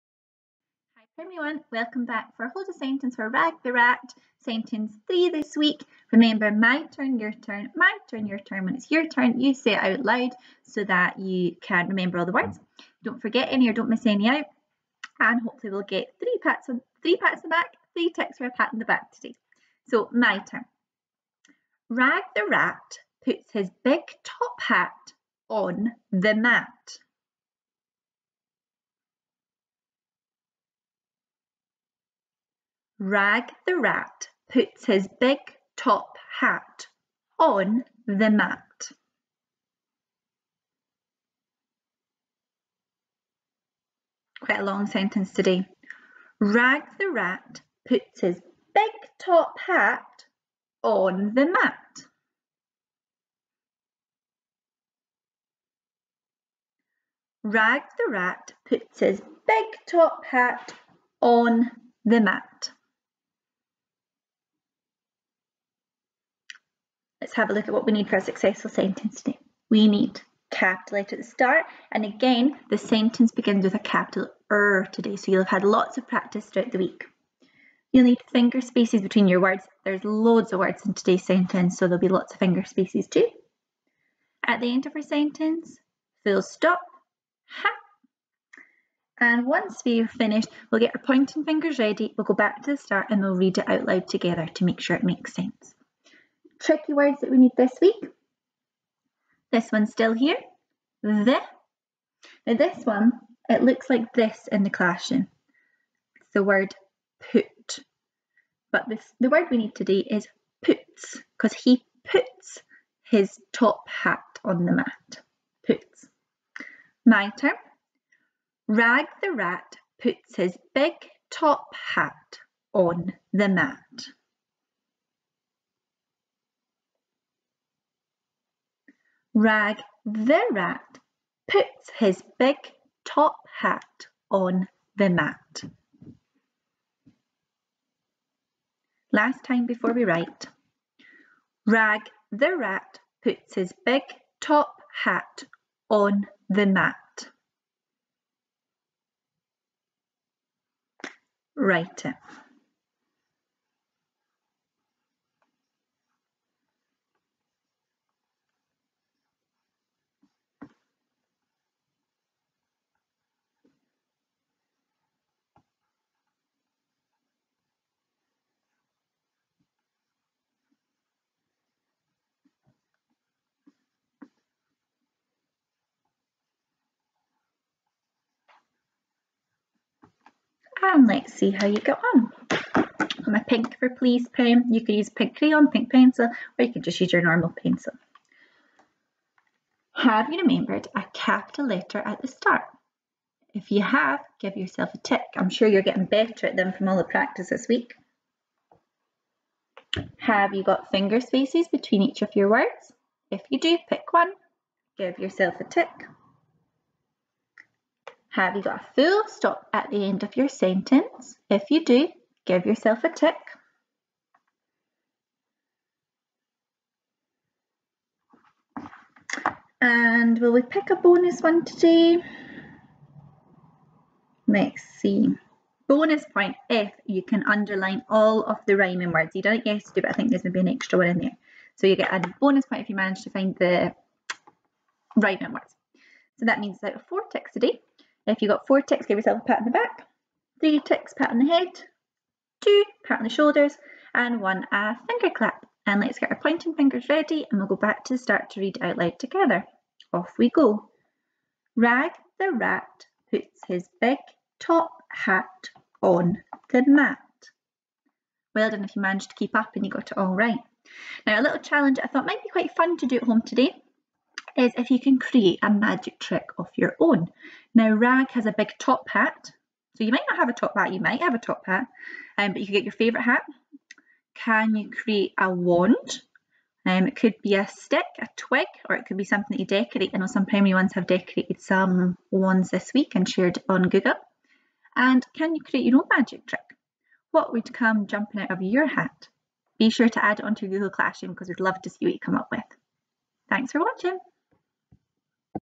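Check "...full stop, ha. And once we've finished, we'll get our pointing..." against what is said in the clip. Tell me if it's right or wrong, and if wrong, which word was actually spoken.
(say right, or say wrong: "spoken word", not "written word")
right.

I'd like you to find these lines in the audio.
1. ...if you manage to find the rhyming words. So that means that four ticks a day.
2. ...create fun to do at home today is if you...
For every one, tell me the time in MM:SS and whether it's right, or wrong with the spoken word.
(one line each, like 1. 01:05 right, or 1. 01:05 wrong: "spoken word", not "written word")
1. 03:52 right
2. 04:22 wrong: "quite", not "create".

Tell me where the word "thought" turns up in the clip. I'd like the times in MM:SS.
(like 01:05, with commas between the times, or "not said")
04:22.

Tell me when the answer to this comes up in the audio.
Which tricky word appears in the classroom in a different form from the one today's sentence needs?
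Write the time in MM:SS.
01:46.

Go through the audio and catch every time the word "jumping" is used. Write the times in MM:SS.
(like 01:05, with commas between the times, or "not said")
04:48.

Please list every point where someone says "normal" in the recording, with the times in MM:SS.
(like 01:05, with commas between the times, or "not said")
03:07.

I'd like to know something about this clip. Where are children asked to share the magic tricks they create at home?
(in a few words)
Google Classroom.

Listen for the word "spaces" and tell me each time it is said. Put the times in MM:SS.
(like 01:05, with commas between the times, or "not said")
01:18, 01:22, 03:21.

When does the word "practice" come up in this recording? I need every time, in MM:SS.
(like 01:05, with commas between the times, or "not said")
01:16, 03:17.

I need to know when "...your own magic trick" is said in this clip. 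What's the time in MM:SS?
04:45.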